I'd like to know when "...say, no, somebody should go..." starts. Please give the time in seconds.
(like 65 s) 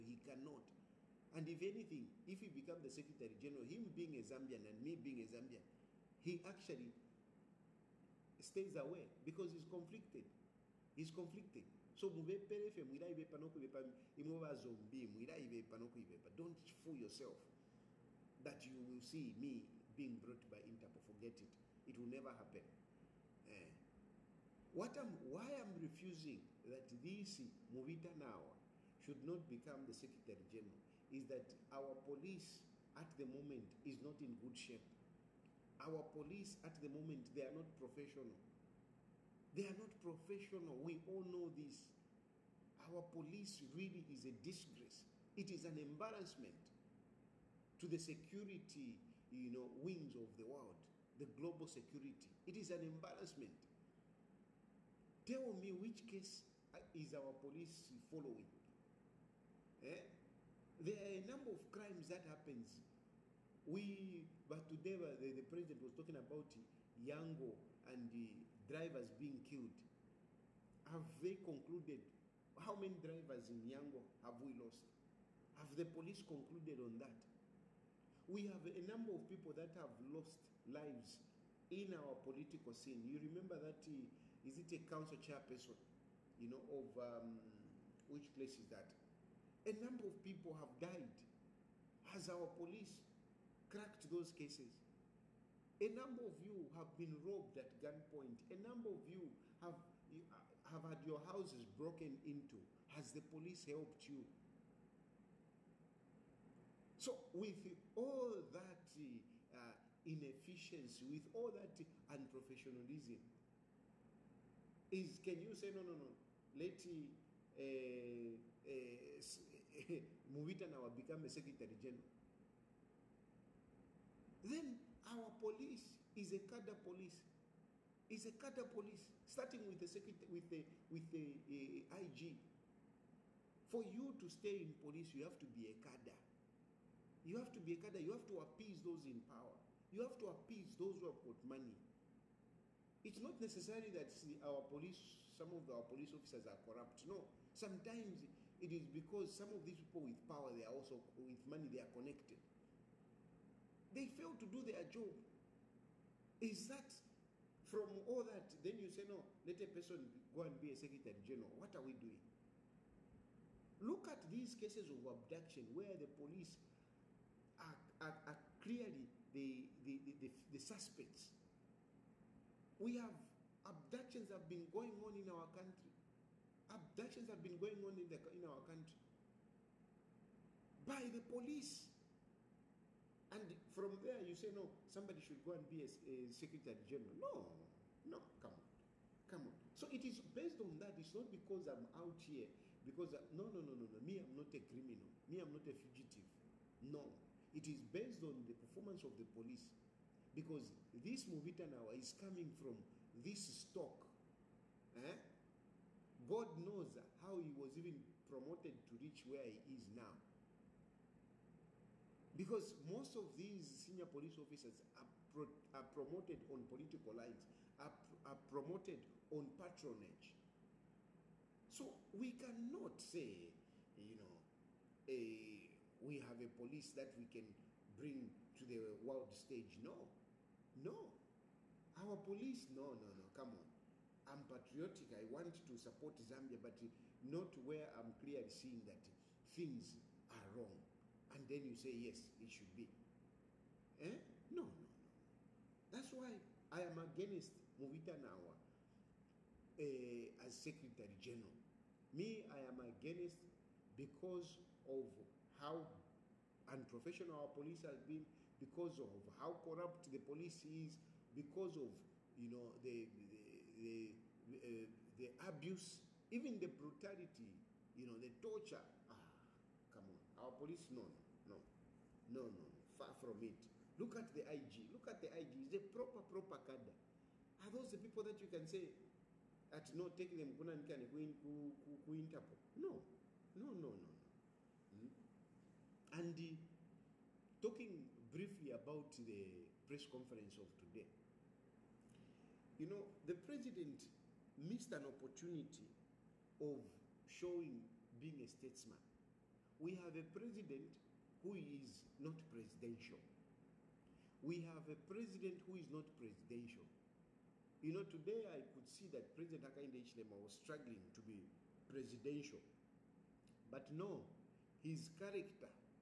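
184 s.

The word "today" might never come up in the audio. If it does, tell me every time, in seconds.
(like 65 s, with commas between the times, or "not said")
64 s, 290 s, 308 s.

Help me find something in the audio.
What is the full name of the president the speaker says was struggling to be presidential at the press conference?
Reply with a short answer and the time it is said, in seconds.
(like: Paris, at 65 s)
Hakainde Hichilema, at 309 s.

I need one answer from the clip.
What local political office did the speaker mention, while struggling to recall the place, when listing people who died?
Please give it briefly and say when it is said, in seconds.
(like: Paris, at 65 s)
council chairperson, at 84 s.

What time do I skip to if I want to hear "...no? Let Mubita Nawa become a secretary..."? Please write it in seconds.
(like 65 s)
115 s.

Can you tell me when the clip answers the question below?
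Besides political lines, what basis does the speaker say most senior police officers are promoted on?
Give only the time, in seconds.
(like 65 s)
219 s.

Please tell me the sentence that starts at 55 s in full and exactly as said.
Tell me which case uh, is our police following?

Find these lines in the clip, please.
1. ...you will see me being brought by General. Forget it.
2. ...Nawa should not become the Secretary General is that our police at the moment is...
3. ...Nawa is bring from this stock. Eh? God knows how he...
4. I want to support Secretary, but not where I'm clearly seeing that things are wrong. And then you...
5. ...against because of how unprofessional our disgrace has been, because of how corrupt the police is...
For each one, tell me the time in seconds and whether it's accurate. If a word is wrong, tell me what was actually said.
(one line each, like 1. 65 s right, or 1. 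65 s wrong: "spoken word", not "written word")
1. 18 s wrong: "Interpol", not "General"
2. 28 s right
3. 201 s wrong: "coming", not "bring"
4. 235 s wrong: "Zambia", not "Secretary"
5. 252 s wrong: "police", not "disgrace".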